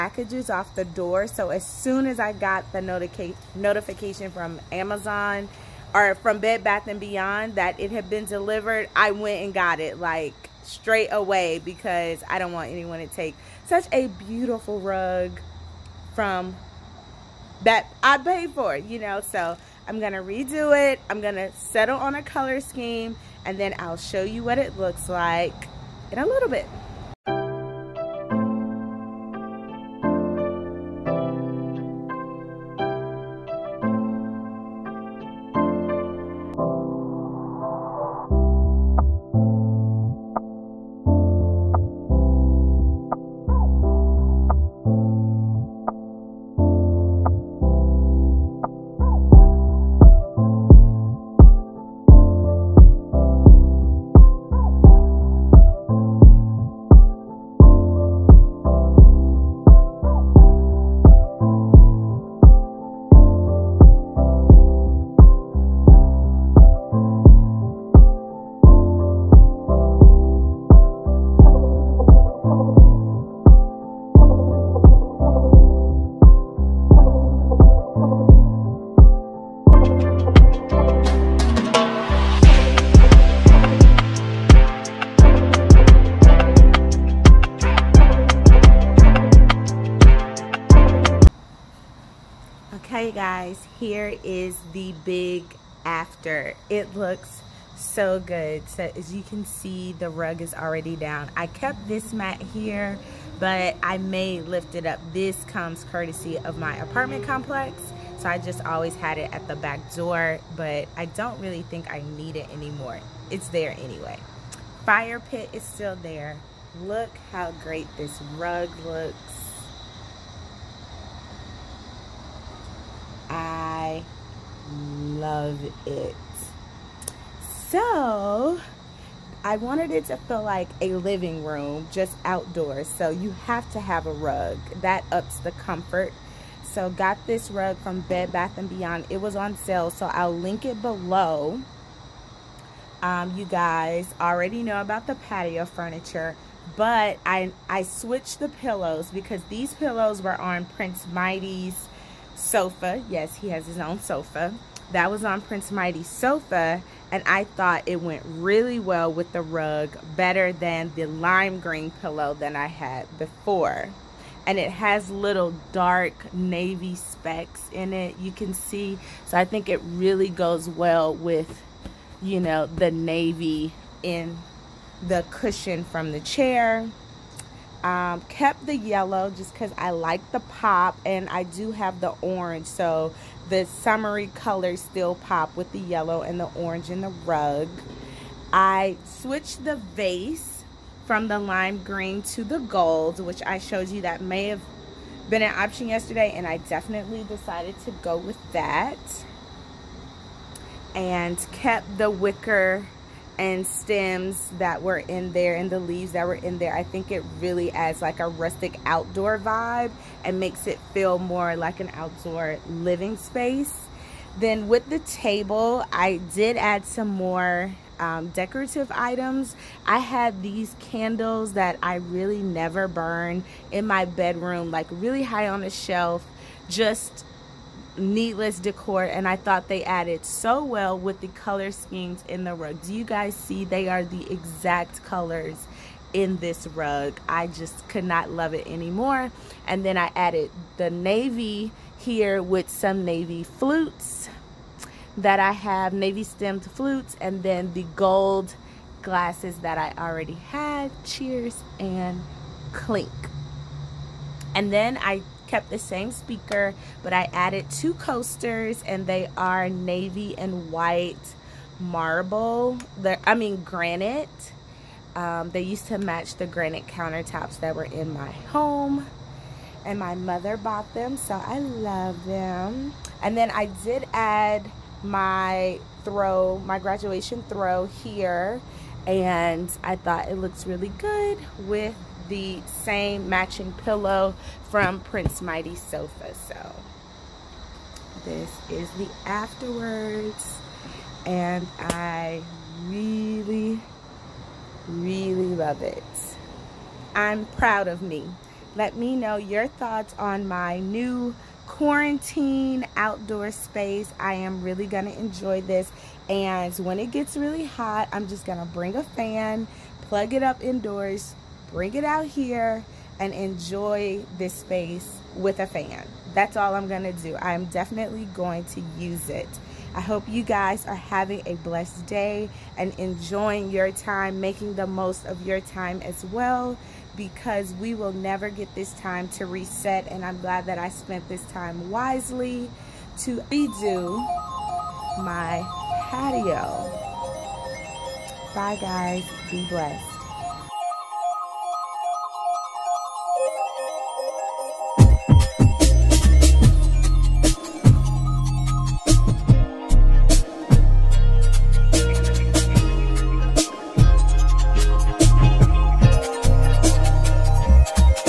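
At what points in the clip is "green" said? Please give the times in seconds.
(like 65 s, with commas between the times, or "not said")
161 s, 191 s.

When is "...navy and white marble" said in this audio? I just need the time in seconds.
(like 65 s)
259 s.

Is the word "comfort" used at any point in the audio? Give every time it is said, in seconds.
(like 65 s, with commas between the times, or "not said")
135 s.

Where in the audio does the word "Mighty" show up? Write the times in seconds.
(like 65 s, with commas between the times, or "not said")
151 s, 155 s, 285 s.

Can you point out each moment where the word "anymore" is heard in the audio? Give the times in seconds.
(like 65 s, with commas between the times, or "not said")
112 s, 238 s.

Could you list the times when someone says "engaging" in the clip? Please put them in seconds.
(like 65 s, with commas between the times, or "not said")
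not said.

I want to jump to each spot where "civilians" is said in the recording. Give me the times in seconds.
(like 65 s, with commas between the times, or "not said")
not said.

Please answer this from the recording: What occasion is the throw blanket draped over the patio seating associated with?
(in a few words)
graduation.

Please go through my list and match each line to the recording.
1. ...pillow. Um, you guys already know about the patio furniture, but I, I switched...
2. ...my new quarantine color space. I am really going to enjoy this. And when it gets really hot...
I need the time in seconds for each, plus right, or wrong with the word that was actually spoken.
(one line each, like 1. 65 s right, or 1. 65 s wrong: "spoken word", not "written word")
1. 140 s wrong: "below", not "pillow"
2. 300 s wrong: "outdoor", not "color".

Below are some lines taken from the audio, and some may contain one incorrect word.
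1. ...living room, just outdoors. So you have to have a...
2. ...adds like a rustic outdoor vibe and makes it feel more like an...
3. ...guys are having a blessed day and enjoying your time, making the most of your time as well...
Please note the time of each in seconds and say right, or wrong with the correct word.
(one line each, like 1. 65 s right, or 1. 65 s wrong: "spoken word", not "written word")
1. 130 s right
2. 207 s right
3. 320 s right.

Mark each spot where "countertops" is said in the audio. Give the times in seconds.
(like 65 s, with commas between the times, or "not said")
266 s.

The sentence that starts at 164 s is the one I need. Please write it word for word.
And it has little dark navy specks in it, you can see.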